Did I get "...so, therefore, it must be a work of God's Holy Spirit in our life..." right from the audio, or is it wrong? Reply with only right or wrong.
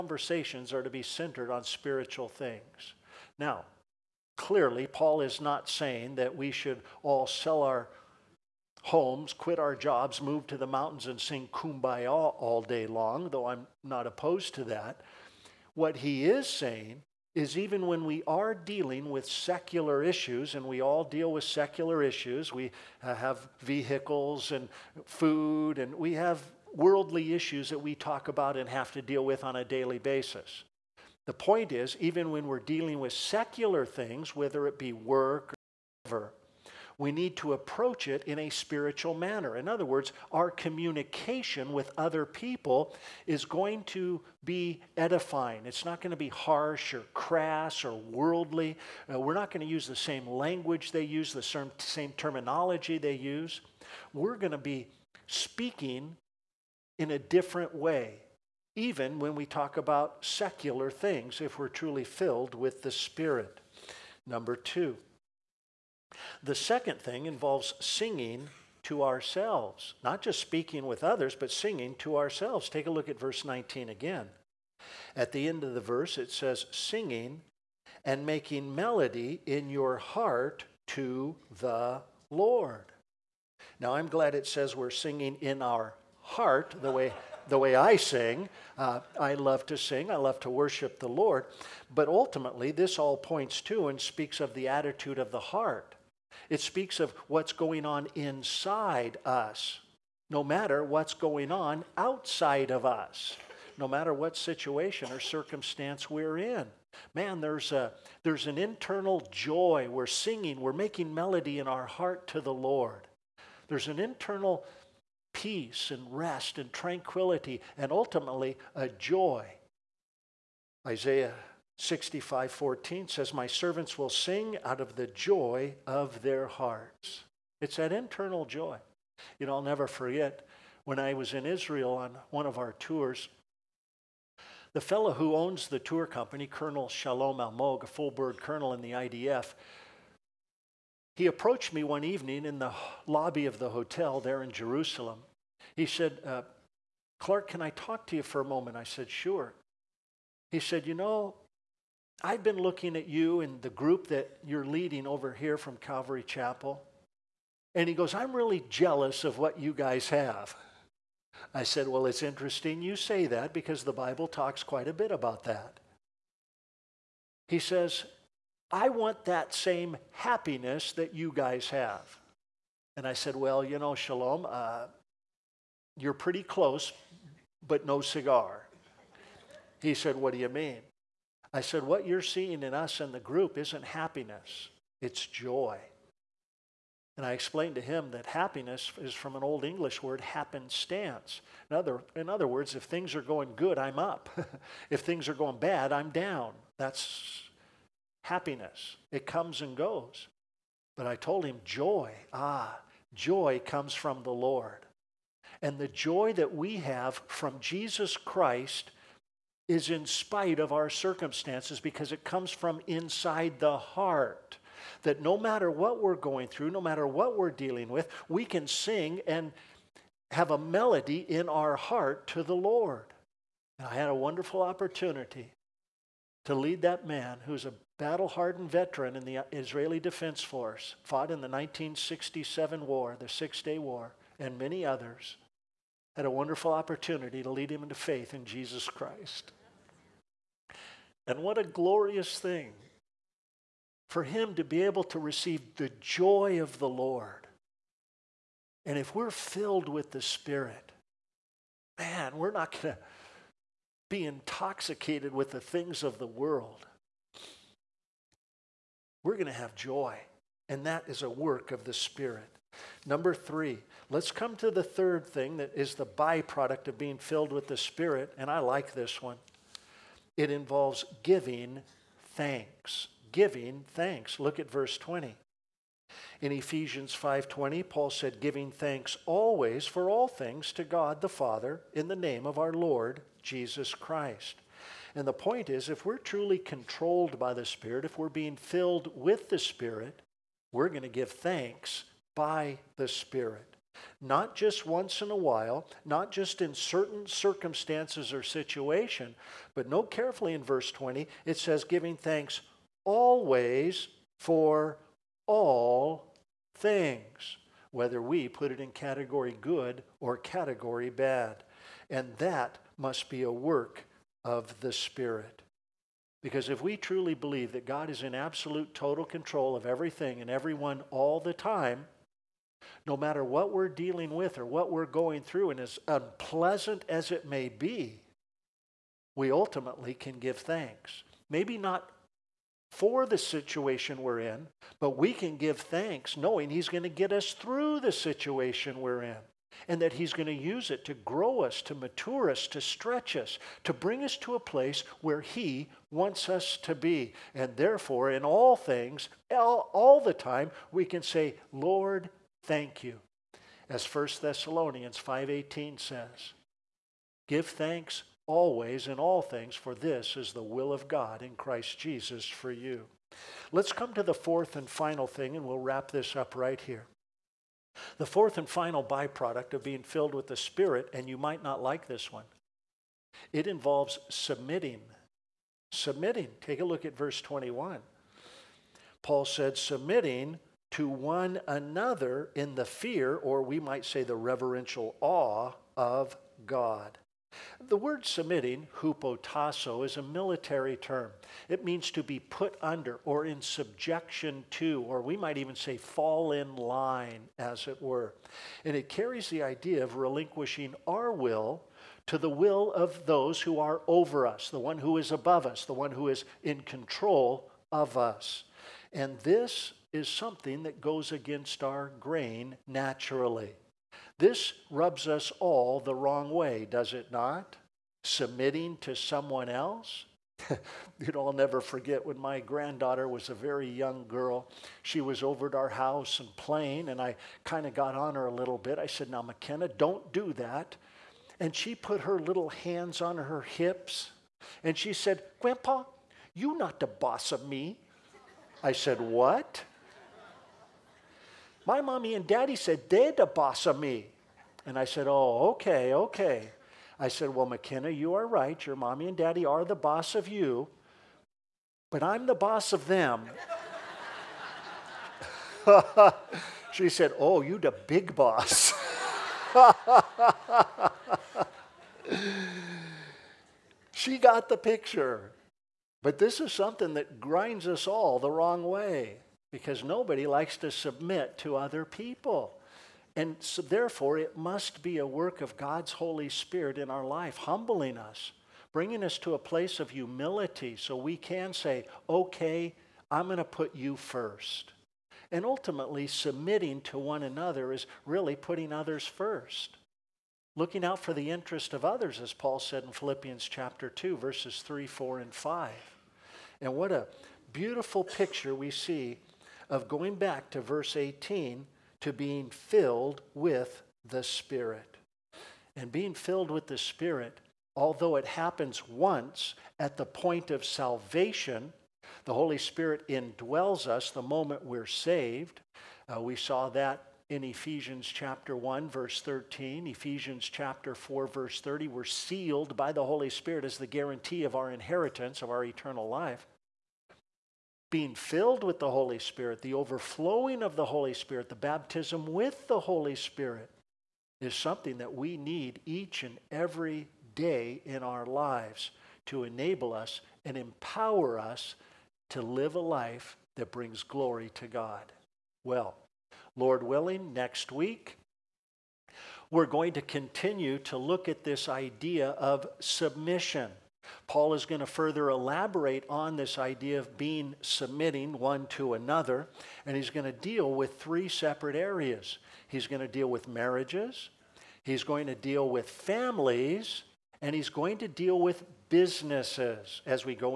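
right.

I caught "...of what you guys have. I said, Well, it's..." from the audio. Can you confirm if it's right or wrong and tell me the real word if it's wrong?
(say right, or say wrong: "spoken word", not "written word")
right.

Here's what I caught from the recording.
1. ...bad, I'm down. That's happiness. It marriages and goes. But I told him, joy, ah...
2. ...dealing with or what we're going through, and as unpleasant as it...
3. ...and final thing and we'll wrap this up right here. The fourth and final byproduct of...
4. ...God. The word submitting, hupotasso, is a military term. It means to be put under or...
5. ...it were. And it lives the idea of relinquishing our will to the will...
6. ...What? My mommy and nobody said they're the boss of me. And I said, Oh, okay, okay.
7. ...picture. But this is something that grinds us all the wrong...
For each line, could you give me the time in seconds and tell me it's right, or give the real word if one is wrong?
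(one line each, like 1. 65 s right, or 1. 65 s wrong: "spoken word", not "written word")
1. 195 s wrong: "comes", not "marriages"
2. 323 s right
3. 364 s right
4. 386 s right
5. 397 s wrong: "carries", not "lives"
6. 439 s wrong: "daddy", not "nobody"
7. 464 s right.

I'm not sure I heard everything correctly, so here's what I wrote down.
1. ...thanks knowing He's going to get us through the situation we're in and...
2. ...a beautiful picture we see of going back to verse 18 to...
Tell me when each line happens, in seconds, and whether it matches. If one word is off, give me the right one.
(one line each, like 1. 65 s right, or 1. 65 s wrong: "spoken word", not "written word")
1. 335 s right
2. 497 s right.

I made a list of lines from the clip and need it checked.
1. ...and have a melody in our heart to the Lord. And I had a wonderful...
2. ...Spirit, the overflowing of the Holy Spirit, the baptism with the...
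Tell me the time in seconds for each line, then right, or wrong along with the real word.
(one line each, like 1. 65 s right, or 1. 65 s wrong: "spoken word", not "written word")
1. 219 s right
2. 529 s right.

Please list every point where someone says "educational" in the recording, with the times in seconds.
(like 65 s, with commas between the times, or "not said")
not said.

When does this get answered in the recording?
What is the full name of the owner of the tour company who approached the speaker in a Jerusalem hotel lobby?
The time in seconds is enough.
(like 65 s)
136 s.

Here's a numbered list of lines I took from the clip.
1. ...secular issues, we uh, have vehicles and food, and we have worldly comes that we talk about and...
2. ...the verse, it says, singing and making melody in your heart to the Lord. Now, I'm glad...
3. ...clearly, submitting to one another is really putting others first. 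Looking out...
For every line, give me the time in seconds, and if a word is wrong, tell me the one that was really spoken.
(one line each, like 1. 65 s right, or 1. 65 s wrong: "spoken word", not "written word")
1. 21 s wrong: "issues", not "comes"
2. 75 s right
3. 485 s wrong: "ultimately", not "clearly".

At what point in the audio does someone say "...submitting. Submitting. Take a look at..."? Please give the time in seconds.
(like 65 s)
374 s.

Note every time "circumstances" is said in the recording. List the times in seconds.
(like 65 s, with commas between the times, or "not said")
105 s, 210 s, 297 s.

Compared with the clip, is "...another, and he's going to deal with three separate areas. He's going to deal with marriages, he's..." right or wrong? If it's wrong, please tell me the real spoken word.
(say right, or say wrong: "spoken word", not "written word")
right.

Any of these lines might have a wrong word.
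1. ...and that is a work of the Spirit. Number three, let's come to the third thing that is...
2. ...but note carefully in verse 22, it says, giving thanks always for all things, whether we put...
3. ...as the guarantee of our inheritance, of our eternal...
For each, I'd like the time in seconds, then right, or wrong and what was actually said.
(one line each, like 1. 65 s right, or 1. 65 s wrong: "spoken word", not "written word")
1. 260 s right
2. 299 s wrong: "20", not "22"
3. 523 s right.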